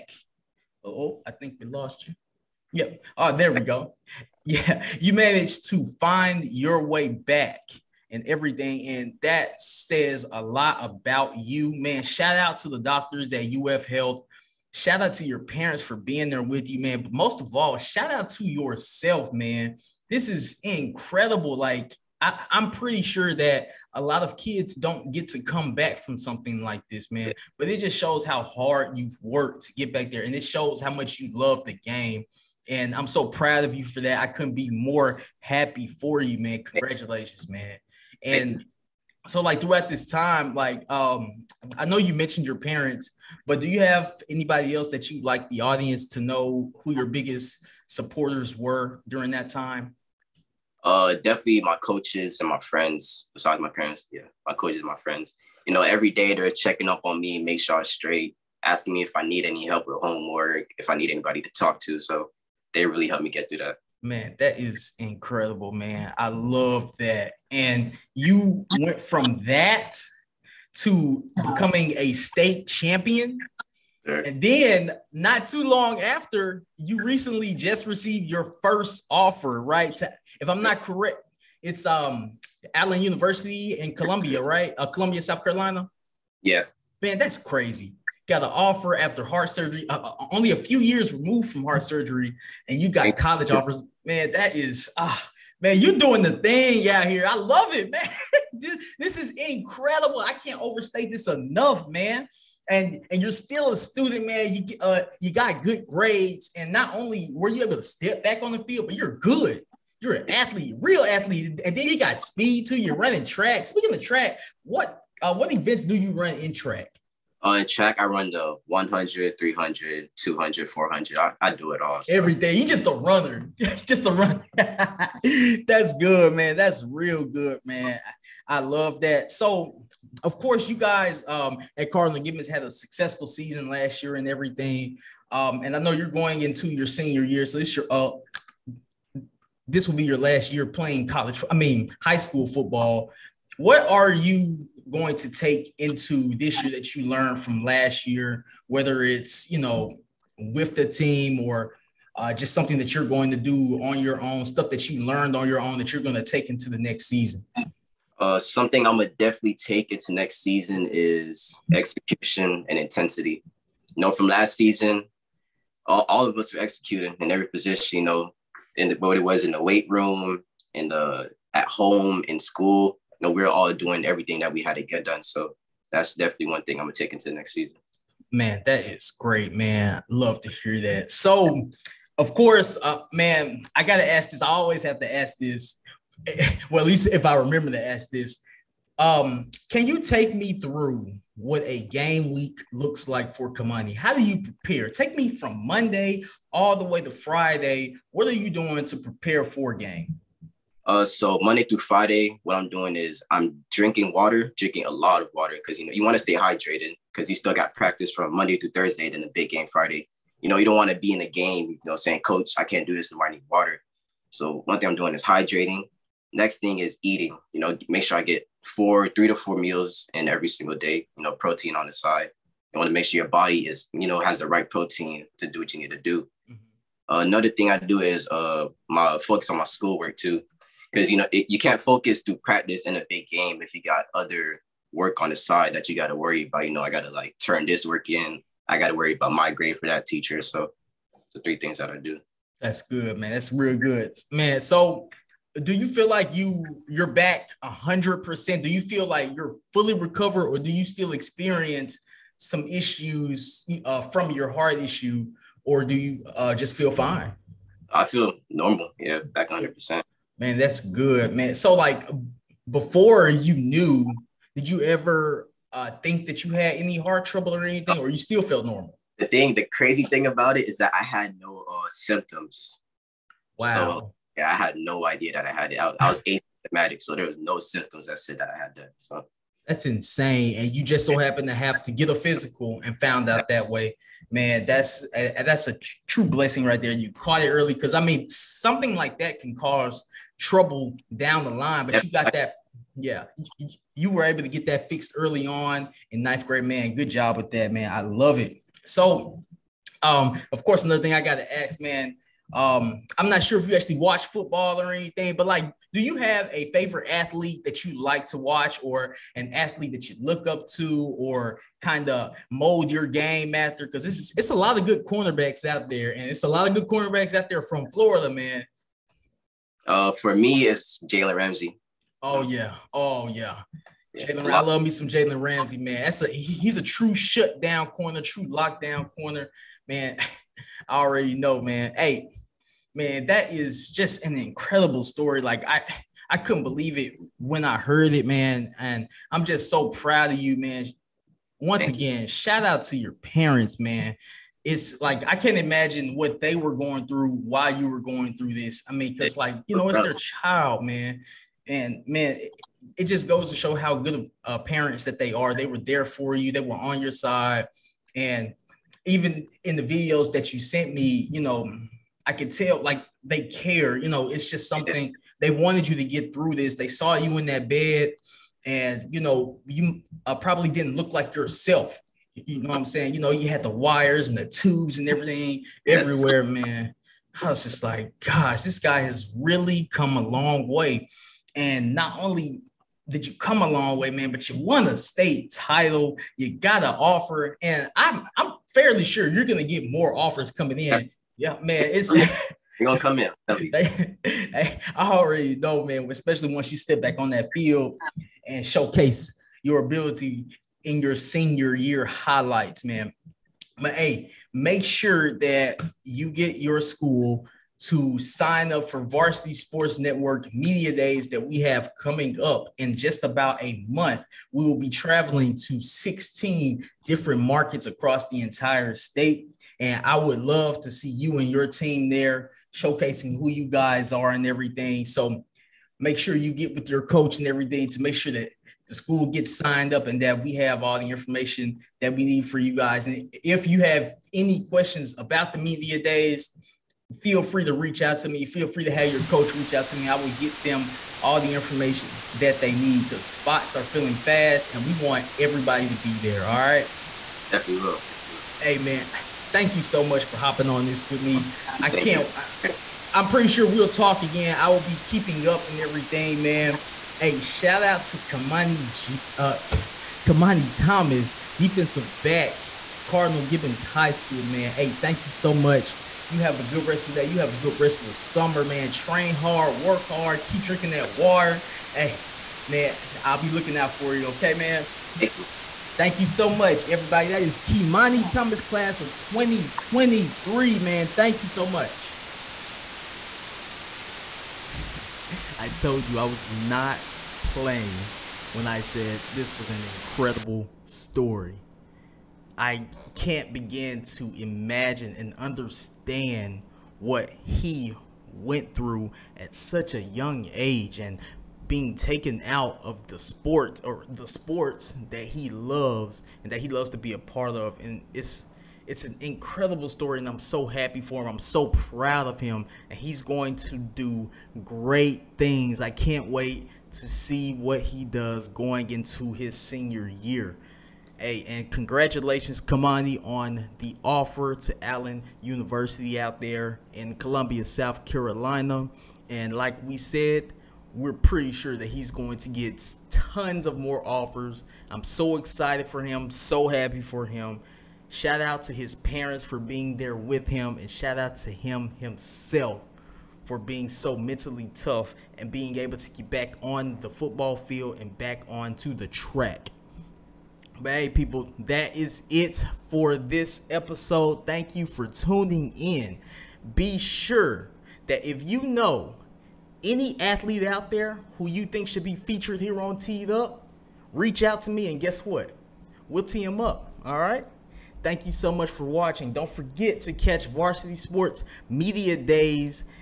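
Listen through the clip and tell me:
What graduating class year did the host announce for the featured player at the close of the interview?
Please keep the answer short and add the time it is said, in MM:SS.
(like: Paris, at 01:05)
2023, at 07:58.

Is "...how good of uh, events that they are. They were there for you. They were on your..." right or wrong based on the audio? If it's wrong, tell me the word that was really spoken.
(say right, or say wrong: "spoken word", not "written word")
wrong: "parents", not "events".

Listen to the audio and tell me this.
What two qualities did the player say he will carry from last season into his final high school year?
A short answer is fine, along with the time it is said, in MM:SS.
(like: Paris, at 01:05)
execution and intensity, at 02:41.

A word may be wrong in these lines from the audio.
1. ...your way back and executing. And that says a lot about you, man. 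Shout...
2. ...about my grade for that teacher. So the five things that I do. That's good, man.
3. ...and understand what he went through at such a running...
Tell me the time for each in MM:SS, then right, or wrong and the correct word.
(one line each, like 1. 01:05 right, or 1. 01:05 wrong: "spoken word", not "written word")
1. 00:06 wrong: "everything", not "executing"
2. 03:59 wrong: "three", not "five"
3. 08:15 wrong: "young", not "running".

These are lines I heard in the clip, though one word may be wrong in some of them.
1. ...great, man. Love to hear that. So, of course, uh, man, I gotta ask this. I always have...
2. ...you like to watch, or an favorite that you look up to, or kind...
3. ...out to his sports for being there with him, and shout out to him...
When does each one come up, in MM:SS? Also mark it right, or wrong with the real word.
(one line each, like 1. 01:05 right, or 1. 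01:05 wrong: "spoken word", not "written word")
1. 02:59 right
2. 05:07 wrong: "athlete", not "favorite"
3. 08:58 wrong: "parents", not "sports".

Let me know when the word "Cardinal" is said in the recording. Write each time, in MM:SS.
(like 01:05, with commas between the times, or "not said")
02:11, 07:43.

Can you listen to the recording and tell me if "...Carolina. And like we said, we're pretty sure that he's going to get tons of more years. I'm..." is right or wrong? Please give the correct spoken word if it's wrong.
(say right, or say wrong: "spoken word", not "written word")
wrong: "offers", not "years".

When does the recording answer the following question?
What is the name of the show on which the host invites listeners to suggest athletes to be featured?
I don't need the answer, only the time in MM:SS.
09:22.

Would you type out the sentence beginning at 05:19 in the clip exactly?
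Uh, for me, it's Jalen Ramsey.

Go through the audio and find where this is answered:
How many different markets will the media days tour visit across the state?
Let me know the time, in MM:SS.
06:55.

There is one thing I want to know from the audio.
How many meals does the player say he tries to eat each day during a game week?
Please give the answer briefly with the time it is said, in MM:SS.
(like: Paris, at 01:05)
3 to 4, at 03:39.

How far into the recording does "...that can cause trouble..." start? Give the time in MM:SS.
04:49.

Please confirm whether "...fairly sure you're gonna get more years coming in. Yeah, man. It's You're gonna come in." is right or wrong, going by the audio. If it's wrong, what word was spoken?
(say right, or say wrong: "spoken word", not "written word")
wrong: "offers", not "years".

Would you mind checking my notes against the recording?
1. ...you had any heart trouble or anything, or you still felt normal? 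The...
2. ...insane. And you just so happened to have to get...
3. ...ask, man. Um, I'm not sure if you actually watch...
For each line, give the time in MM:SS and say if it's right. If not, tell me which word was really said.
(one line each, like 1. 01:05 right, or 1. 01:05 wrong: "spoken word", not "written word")
1. 04:26 right
2. 04:39 right
3. 05:01 right.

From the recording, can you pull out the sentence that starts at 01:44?
You uh you got good grades, and not only were you able to step back on the field, but you're good.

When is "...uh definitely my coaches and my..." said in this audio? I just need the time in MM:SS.
00:50.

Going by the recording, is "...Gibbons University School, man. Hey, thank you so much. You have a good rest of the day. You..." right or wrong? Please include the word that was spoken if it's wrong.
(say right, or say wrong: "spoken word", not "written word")
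wrong: "High", not "University".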